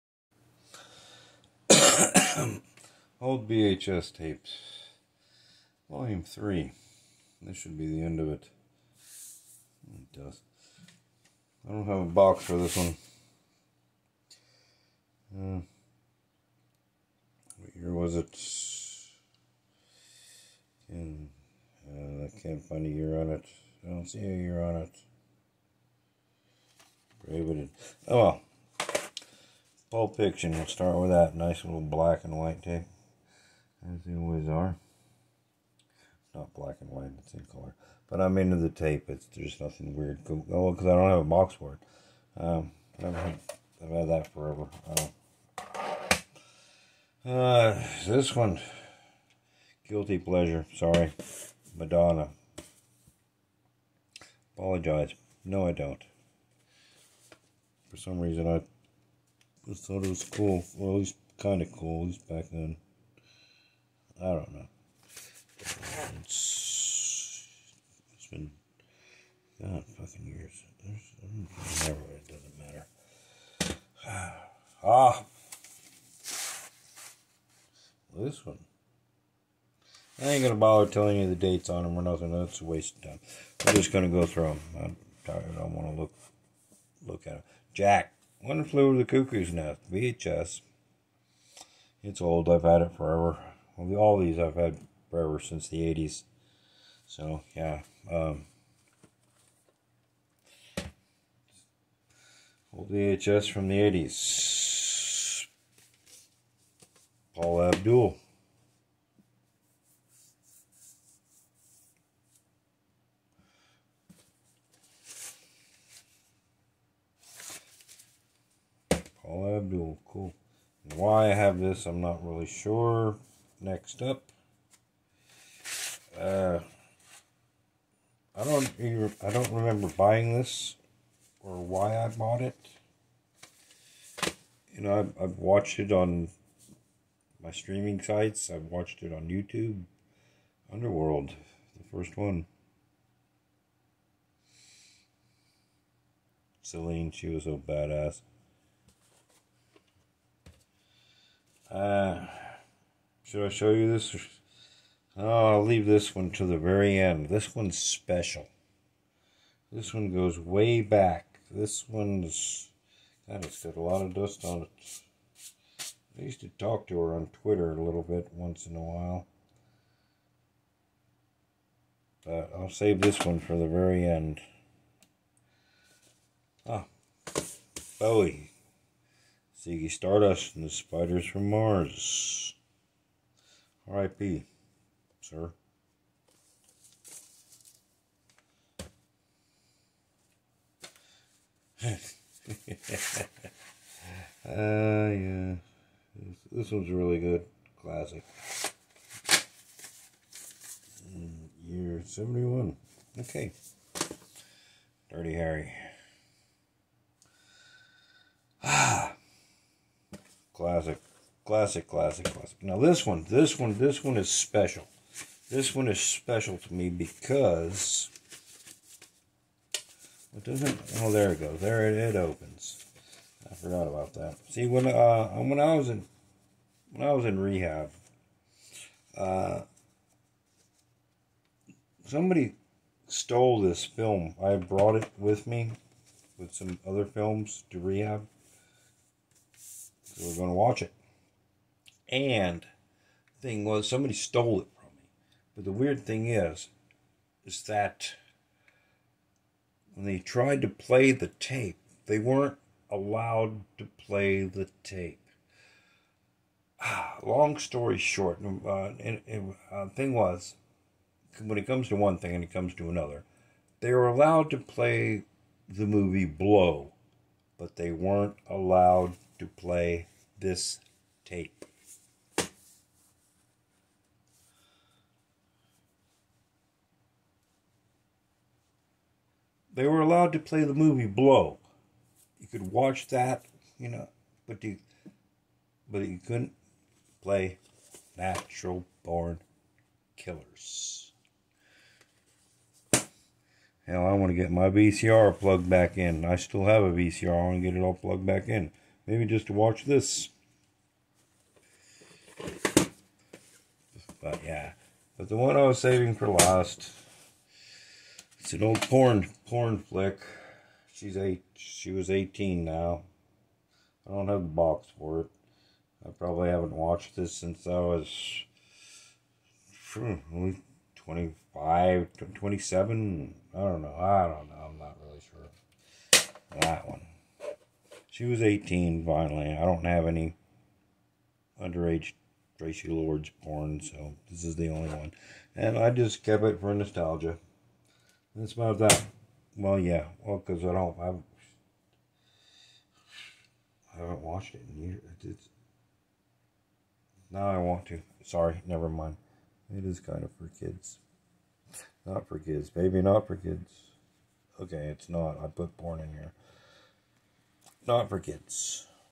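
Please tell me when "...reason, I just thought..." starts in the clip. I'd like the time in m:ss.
0:58.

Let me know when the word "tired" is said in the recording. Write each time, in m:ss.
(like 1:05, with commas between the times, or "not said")
1:25.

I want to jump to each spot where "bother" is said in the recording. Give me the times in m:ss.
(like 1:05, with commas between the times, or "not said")
1:20.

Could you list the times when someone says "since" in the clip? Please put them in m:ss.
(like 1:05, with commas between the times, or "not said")
1:35, 5:17.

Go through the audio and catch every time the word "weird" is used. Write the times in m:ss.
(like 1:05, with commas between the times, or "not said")
0:39, 4:05.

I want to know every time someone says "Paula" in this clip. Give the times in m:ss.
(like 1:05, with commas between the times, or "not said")
1:47.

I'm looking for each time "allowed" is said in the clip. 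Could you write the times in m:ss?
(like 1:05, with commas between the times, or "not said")
4:12, 4:24, 4:28, 4:40.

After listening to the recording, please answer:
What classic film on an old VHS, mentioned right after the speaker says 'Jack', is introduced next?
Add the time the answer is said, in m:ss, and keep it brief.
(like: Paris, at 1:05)
One Flew Over the Cuckoo's Nest, at 1:28.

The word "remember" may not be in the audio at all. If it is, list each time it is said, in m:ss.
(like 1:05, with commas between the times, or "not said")
2:09.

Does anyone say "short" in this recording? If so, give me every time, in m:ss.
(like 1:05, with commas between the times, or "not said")
4:17.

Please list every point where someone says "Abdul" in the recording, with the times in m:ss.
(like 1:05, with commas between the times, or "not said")
1:47, 1:59.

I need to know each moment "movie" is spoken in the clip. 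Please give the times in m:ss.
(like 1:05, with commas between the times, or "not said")
4:25, 4:40.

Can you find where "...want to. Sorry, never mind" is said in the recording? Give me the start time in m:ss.
5:47.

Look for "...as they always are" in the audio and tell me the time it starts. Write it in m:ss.
0:33.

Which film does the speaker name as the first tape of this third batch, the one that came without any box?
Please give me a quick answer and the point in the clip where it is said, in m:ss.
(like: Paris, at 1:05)
Pulp Fiction, at 0:29.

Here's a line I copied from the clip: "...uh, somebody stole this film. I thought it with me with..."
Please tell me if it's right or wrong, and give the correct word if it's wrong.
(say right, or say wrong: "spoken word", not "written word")
wrong: "brought", not "thought".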